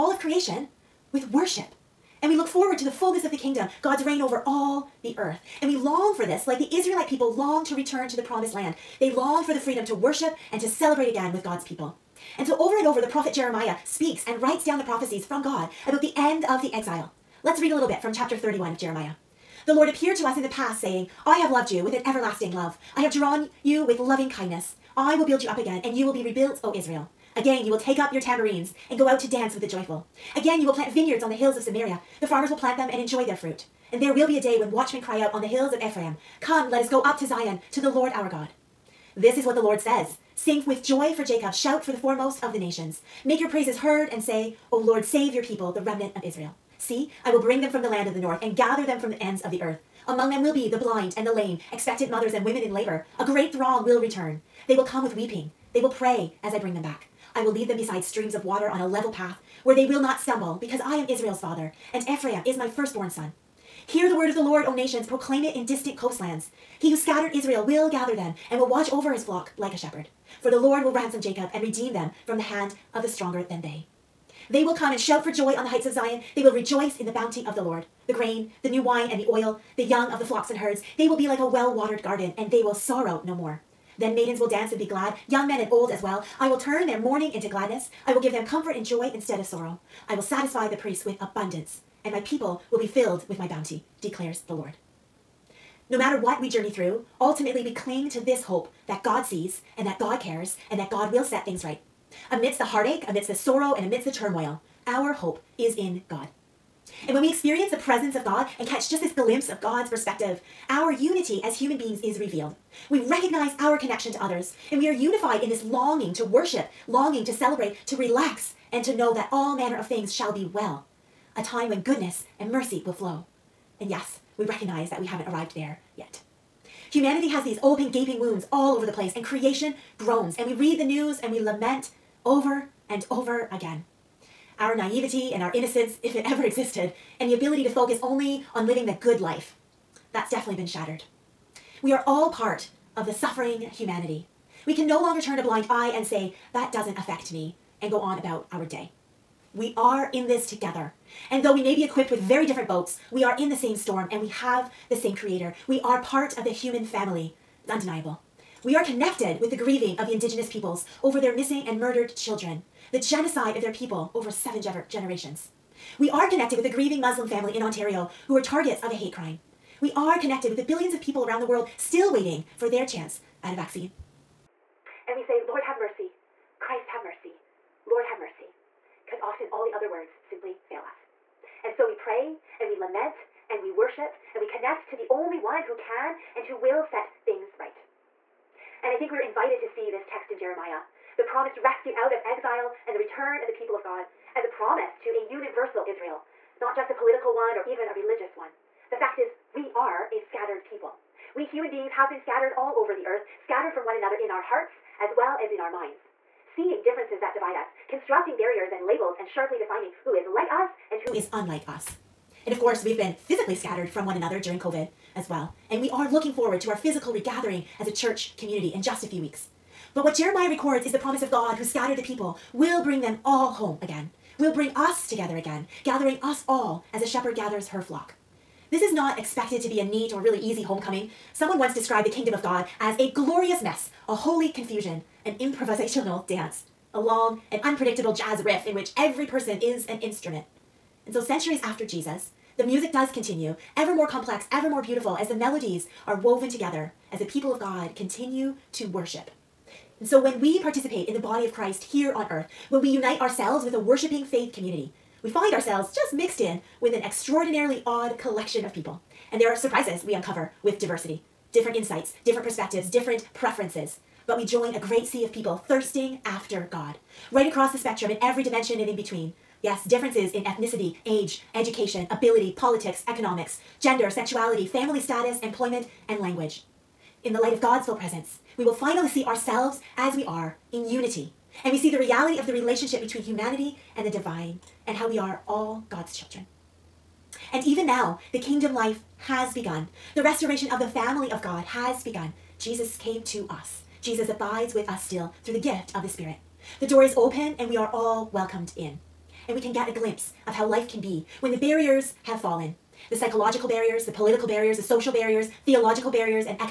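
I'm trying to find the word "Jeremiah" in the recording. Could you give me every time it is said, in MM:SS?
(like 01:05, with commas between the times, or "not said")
00:13, 00:18, 03:10, 03:40.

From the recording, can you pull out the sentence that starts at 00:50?
Among them will be the blind and the lame, expectant mothers and women in labor.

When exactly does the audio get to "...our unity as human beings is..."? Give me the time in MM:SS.
01:50.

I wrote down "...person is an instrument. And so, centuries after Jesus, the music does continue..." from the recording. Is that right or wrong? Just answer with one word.
right.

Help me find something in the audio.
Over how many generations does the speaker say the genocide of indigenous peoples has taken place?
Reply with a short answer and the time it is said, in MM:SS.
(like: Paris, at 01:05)
7, at 02:44.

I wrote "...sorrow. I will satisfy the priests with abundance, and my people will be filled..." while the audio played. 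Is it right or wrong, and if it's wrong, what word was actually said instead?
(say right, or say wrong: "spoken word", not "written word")
right.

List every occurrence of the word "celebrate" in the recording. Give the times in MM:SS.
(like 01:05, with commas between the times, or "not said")
00:10, 01:57.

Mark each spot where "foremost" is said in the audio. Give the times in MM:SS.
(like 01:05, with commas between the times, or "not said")
00:41.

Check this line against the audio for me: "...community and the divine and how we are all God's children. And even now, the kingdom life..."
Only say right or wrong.
wrong.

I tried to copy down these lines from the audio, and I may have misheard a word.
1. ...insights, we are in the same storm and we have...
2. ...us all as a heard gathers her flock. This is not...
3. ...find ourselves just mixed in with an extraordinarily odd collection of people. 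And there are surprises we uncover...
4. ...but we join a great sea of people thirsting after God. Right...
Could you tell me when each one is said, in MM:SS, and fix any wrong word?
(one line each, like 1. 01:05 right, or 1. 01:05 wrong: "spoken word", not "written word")
1. 02:32 wrong: "boats", not "insights"
2. 03:46 wrong: "shepherd", not "heard"
3. 04:15 right
4. 04:24 right.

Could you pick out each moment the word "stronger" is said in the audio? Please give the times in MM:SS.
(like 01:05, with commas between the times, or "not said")
01:13.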